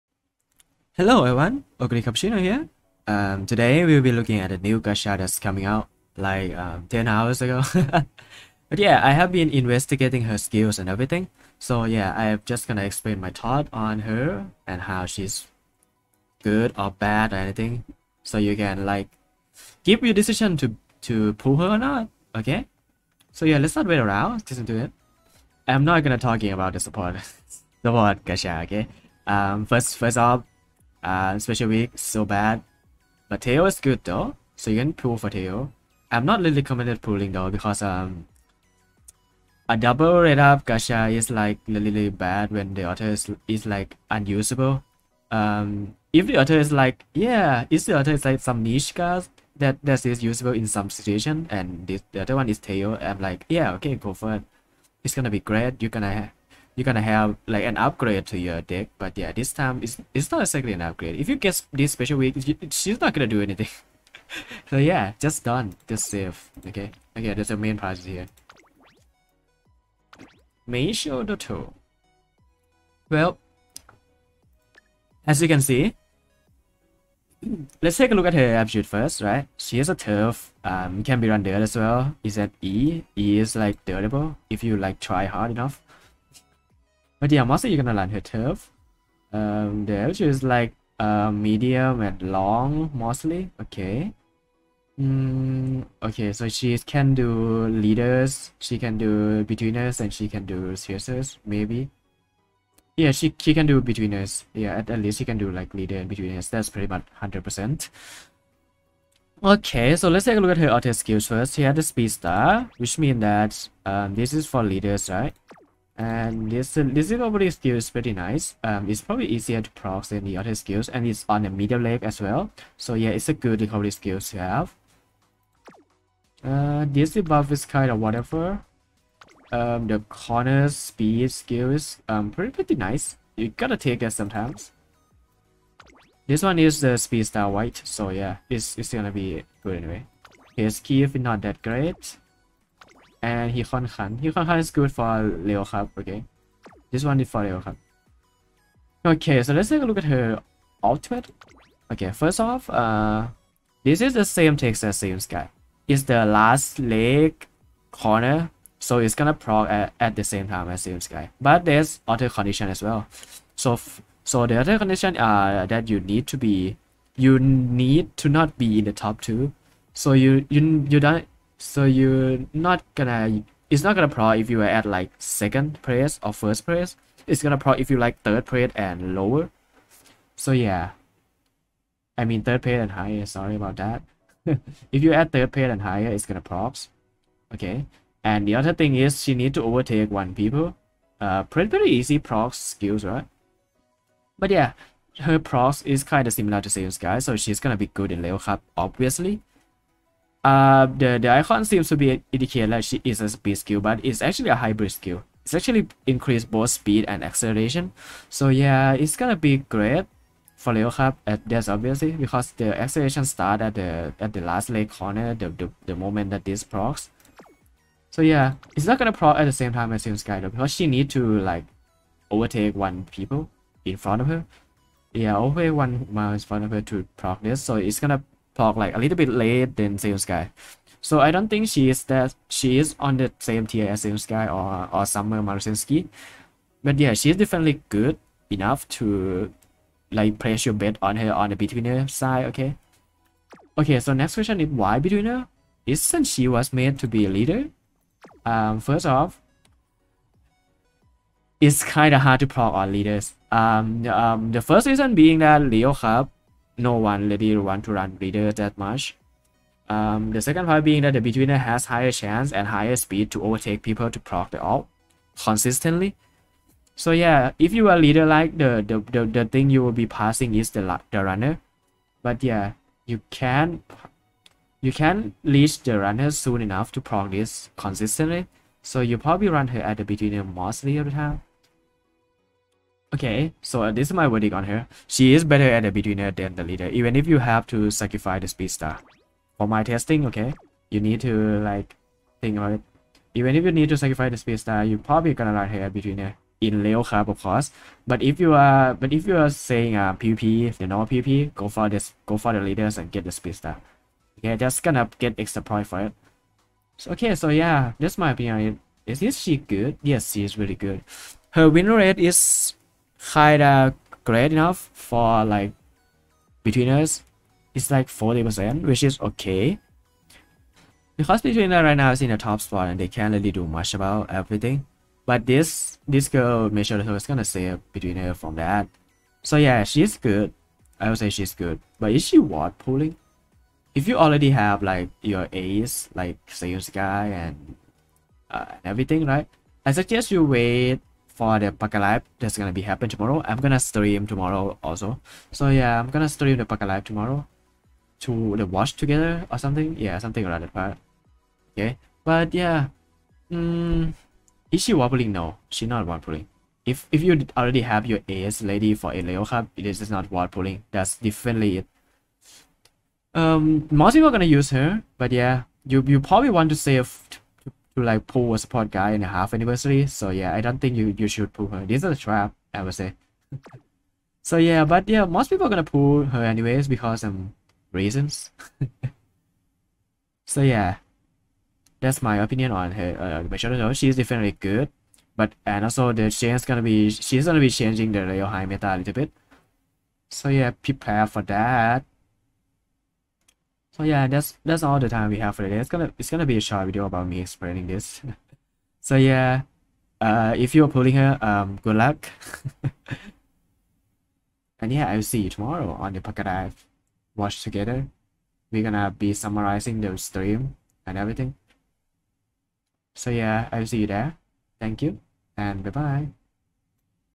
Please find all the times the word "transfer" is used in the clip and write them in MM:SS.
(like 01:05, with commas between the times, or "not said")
not said.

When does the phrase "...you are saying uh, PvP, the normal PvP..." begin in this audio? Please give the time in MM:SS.
04:59.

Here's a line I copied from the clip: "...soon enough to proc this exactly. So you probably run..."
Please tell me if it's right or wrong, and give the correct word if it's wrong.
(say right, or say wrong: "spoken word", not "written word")
wrong: "consistently", not "exactly".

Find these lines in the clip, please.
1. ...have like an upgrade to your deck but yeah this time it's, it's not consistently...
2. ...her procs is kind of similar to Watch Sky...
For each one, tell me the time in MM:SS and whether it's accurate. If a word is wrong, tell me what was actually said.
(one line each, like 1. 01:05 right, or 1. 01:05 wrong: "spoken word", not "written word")
1. 00:57 wrong: "exactly", not "consistently"
2. 03:15 wrong: "Seiun", not "Watch".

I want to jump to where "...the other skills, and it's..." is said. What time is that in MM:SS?
02:00.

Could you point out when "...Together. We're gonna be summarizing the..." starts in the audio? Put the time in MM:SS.
06:47.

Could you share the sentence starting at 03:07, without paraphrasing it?
Okay, and the other thing is she need to overtake one people.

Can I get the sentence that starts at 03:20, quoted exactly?
Uh, the, the icon seems to be indicate that she is a speed skill, but it's actually a hybrid skill.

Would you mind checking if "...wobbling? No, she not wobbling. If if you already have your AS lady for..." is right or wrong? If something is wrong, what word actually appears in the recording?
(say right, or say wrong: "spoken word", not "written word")
right.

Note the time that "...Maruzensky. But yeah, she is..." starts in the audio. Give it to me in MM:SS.
03:55.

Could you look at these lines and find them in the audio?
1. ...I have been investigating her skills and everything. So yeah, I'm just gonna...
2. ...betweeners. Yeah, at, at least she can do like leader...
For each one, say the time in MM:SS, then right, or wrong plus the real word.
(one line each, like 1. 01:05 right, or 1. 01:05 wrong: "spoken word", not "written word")
1. 00:09 right
2. 01:43 right.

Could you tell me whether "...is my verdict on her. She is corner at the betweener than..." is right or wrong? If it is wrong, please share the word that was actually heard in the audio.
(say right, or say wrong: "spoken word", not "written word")
wrong: "better", not "corner".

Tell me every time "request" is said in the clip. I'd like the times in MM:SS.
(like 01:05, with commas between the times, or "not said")
not said.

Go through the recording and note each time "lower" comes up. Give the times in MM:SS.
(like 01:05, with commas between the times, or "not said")
02:59.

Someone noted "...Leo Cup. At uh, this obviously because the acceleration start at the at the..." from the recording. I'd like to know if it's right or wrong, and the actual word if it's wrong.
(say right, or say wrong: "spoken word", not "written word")
right.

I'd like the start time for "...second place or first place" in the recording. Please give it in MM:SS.
02:55.